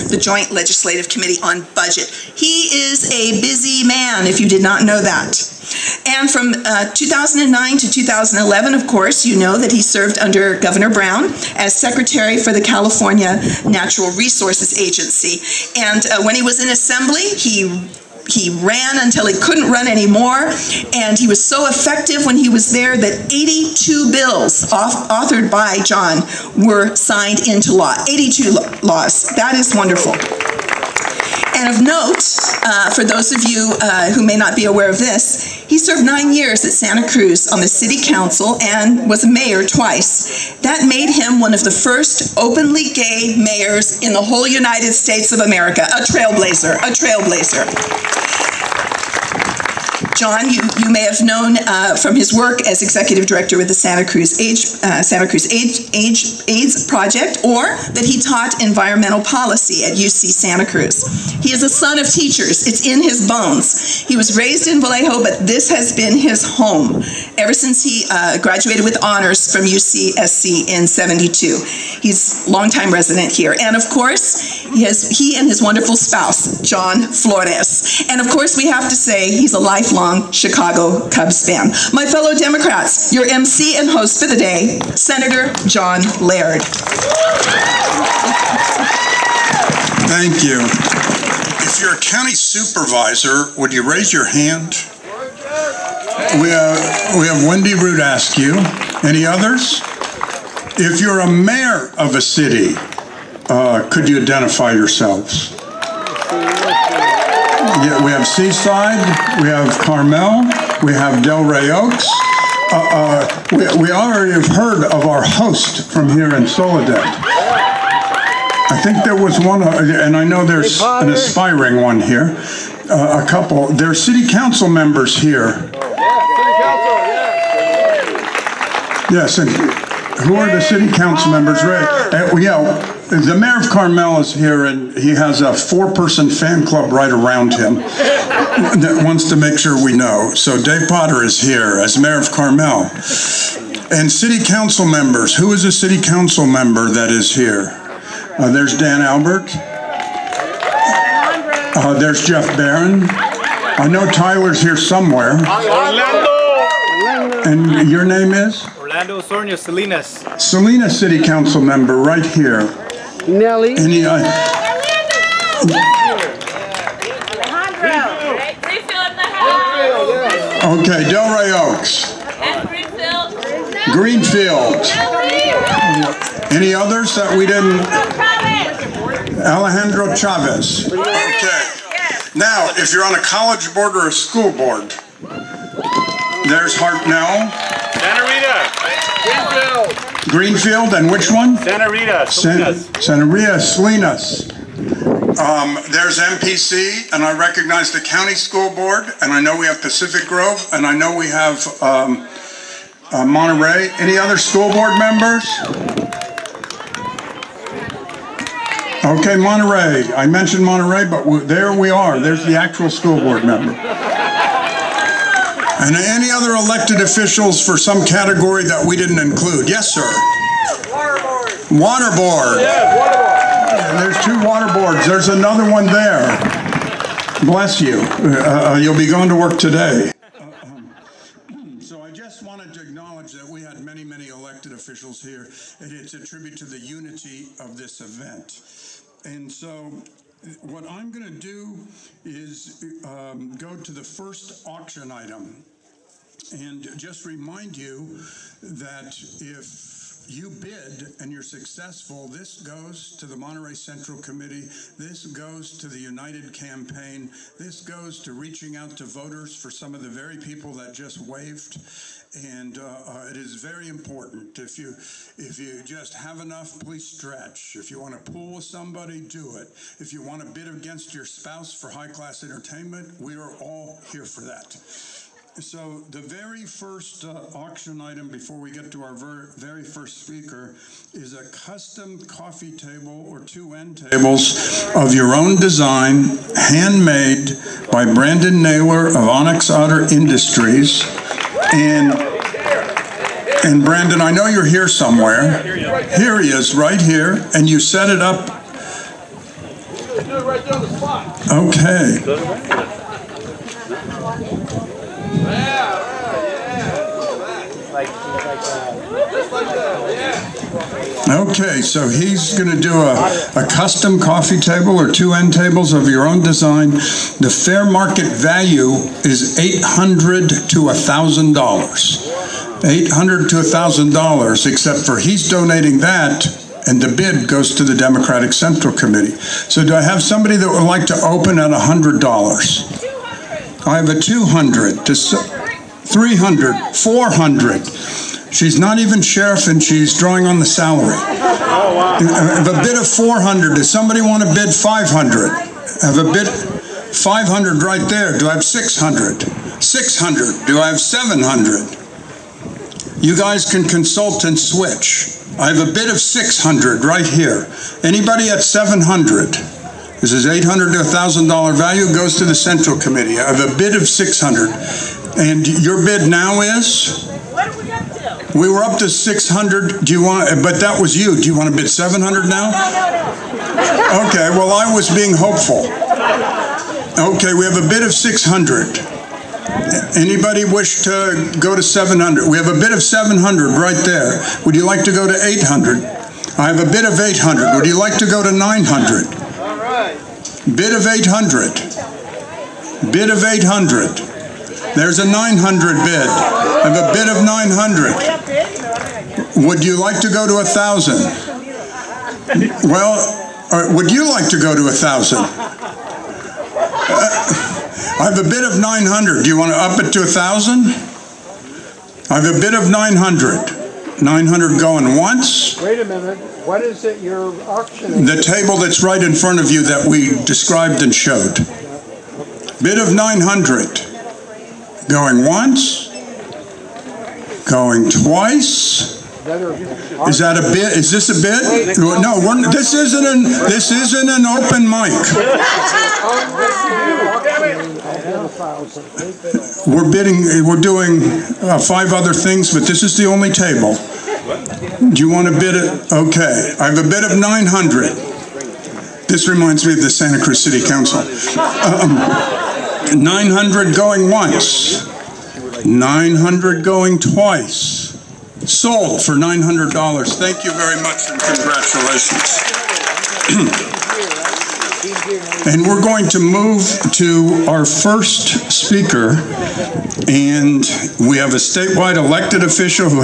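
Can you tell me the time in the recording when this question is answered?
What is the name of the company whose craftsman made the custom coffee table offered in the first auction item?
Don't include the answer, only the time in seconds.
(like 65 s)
289 s.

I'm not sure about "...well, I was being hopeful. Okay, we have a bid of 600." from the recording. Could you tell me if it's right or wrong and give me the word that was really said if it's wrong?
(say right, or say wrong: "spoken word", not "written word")
right.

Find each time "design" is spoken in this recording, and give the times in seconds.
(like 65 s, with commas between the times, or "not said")
285 s, 316 s.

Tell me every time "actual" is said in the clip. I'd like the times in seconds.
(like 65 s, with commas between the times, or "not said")
212 s.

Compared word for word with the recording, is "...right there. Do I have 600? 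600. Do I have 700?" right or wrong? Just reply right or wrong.
right.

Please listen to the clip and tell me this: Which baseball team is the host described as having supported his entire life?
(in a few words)
Chicago Cubs.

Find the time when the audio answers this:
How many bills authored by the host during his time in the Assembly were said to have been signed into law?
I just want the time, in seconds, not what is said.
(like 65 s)
23 s.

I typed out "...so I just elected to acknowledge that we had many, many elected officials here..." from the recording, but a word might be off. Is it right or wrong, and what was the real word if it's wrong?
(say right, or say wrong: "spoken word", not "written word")
wrong: "wanted", not "elected".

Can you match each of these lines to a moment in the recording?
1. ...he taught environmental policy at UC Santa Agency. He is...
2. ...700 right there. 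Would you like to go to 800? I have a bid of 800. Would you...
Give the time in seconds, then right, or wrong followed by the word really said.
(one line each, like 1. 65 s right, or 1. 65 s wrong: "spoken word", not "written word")
1. 58 s wrong: "Cruz", not "Agency"
2. 383 s right.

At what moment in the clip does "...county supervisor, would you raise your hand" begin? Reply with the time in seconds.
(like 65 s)
92 s.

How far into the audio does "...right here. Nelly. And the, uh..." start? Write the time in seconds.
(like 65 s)
161 s.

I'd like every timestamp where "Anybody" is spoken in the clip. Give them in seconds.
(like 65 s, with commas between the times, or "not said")
358 s, 380 s.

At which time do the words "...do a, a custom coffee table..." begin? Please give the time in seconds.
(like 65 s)
312 s.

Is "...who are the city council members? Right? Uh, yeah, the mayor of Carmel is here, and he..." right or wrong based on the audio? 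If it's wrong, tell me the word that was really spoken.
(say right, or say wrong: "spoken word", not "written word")
right.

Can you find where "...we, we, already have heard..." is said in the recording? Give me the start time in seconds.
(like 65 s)
113 s.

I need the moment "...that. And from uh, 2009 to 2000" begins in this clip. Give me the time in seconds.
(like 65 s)
5 s.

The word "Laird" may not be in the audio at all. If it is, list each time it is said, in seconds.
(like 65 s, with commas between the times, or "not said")
86 s.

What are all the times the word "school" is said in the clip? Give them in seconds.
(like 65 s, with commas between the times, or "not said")
184 s, 198 s, 204 s, 212 s.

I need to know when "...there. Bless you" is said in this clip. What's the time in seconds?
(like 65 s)
225 s.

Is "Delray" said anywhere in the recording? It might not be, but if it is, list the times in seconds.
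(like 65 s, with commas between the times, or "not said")
171 s.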